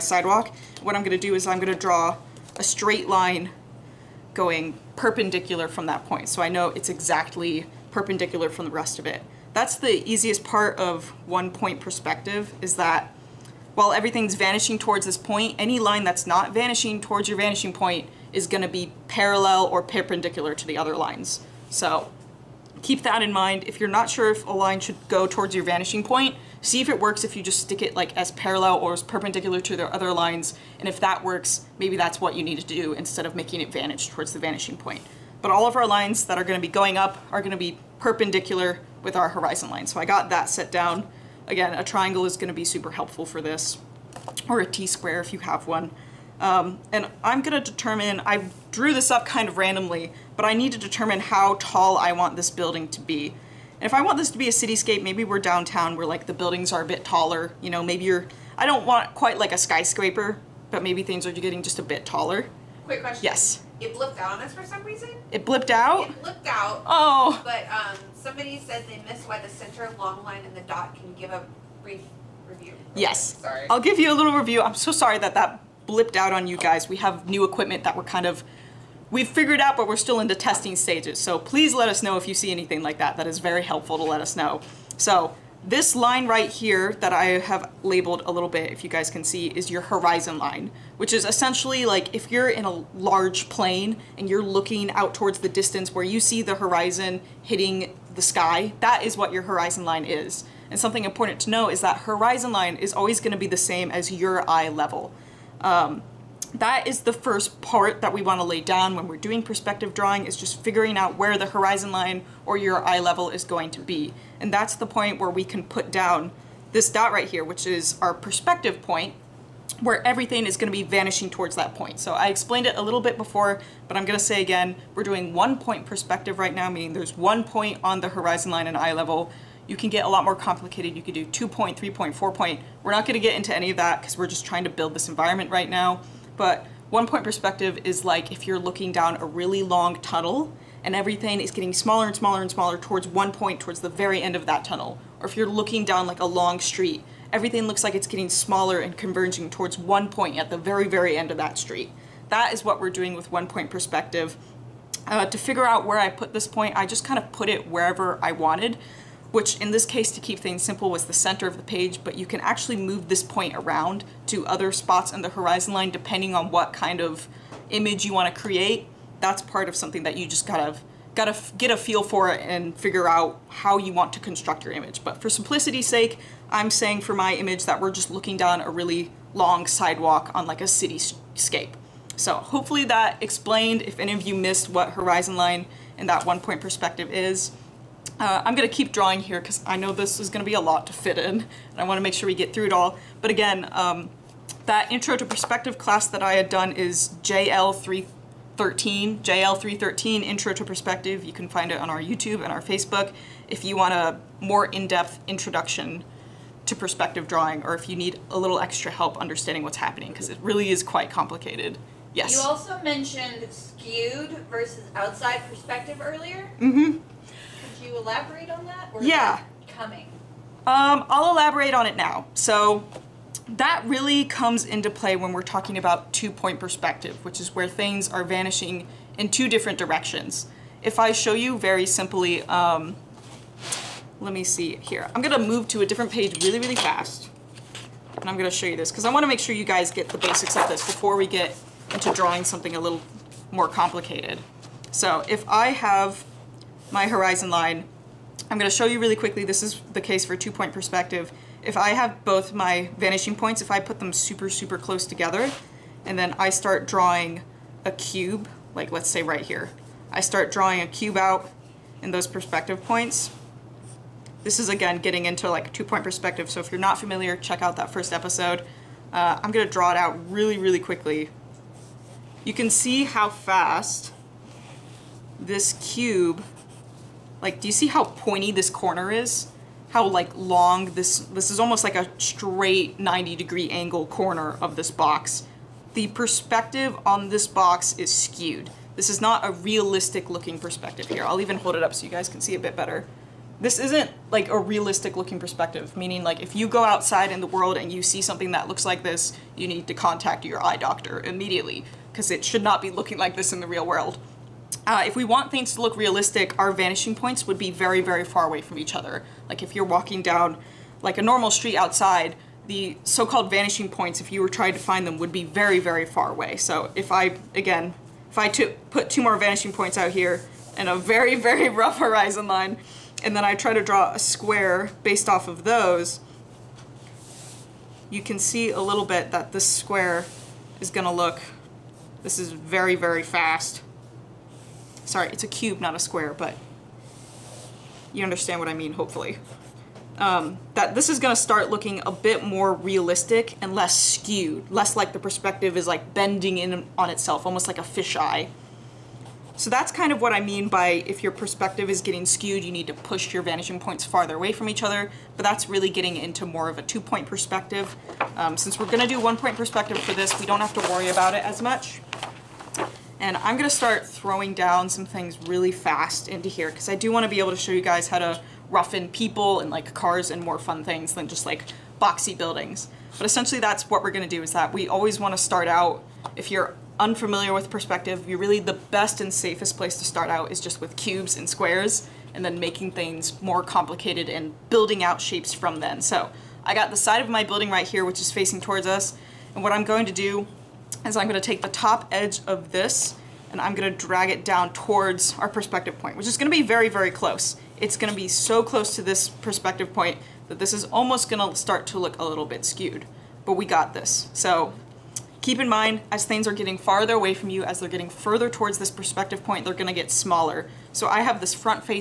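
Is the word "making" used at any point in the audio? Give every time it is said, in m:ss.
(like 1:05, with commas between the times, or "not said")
0:33, 6:22.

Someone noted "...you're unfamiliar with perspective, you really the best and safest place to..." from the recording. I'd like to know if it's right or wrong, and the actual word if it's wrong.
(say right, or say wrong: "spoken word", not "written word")
right.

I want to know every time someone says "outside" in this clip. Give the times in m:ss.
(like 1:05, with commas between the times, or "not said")
3:34, 4:56, 5:11.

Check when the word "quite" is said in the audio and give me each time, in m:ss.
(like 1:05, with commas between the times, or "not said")
0:59, 3:30.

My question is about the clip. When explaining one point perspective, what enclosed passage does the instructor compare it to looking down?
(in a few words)
A really long tunnel.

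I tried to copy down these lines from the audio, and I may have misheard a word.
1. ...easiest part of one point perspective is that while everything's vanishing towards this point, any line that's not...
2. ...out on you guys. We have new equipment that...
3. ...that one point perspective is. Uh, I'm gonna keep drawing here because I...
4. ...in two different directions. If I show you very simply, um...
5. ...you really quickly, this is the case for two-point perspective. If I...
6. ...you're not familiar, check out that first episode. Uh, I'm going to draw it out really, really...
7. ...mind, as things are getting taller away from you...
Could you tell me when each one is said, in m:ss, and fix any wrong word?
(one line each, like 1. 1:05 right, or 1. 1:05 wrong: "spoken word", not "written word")
1. 0:10 right
2. 1:16 right
3. 3:06 right
4. 3:49 right
5. 4:08 right
6. 4:26 right
7. 6:45 wrong: "farther", not "taller".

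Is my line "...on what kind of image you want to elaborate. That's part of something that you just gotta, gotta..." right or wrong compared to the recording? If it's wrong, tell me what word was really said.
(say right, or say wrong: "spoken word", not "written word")
wrong: "create", not "elaborate".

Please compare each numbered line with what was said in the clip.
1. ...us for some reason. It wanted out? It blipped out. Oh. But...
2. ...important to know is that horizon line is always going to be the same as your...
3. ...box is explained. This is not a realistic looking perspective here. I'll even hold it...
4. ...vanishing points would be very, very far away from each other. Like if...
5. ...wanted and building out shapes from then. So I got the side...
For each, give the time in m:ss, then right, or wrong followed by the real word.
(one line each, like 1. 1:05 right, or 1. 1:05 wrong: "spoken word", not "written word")
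1. 1:04 wrong: "blipped", not "wanted"
2. 1:41 right
3. 4:47 wrong: "skewed", not "explained"
4. 5:06 right
5. 6:23 wrong: "complicated", not "wanted".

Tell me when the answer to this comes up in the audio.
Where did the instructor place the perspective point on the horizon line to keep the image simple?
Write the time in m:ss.
2:41.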